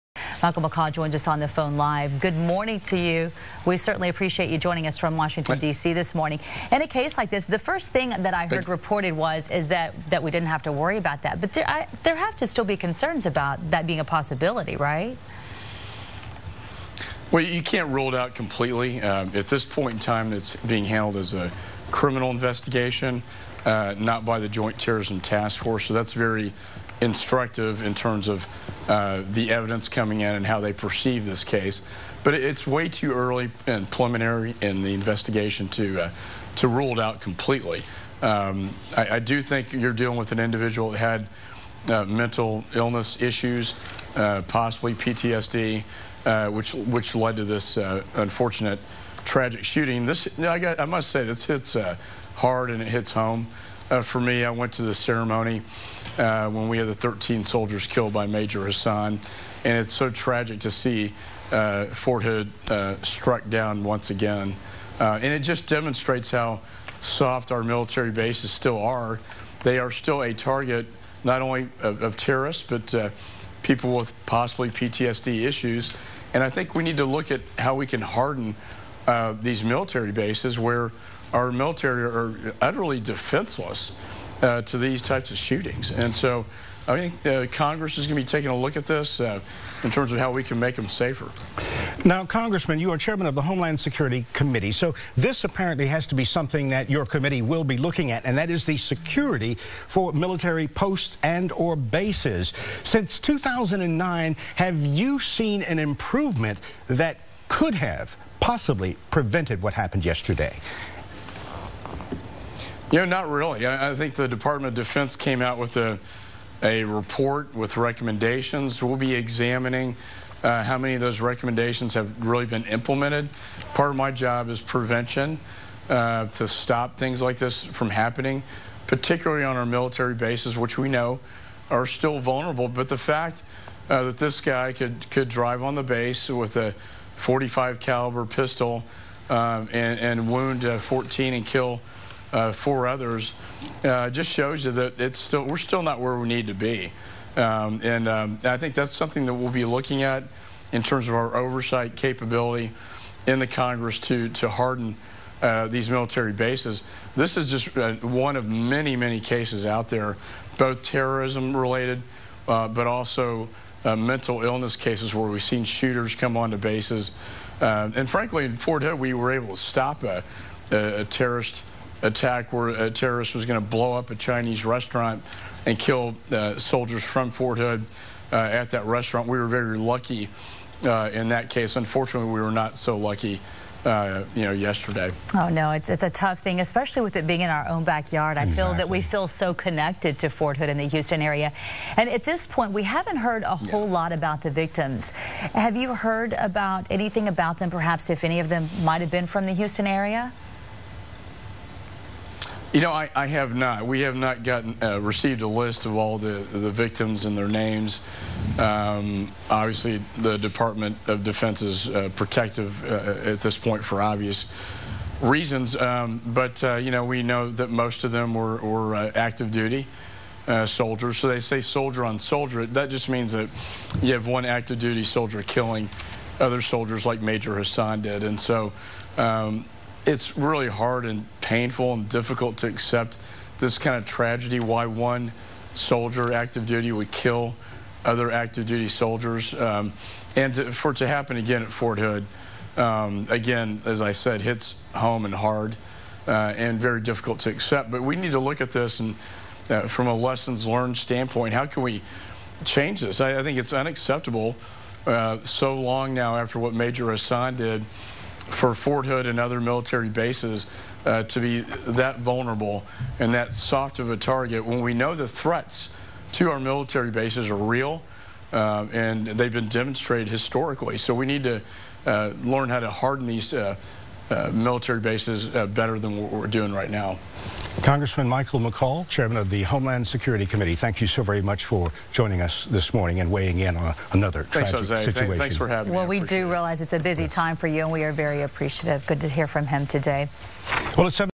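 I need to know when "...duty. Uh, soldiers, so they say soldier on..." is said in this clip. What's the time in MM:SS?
03:39.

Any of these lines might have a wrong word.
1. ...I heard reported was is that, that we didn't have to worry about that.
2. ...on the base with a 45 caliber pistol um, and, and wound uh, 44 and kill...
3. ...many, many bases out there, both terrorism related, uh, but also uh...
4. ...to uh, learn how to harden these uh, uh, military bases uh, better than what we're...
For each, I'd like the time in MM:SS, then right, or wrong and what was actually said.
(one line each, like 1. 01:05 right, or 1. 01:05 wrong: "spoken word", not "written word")
1. 00:08 right
2. 02:15 wrong: "14", not "44"
3. 02:38 wrong: "cases", not "bases"
4. 04:31 right.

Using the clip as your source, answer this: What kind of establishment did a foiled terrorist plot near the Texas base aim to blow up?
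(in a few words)
Chinese restaurant.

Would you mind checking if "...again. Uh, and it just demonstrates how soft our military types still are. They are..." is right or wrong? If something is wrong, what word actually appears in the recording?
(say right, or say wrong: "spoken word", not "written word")
wrong: "bases", not "types".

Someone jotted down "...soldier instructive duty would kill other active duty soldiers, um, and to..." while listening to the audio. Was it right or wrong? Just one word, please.
wrong.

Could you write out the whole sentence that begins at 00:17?
Well, you can't rule it out completely.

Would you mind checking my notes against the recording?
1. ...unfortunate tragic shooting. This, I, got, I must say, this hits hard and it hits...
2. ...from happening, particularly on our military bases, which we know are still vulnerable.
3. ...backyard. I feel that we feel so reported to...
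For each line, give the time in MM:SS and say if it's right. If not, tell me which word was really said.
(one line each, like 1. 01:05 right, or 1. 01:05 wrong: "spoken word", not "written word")
1. 00:48 right
2. 02:07 right
3. 03:07 wrong: "connected", not "reported".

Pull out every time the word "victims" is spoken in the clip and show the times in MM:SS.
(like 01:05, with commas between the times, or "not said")
03:14, 03:26.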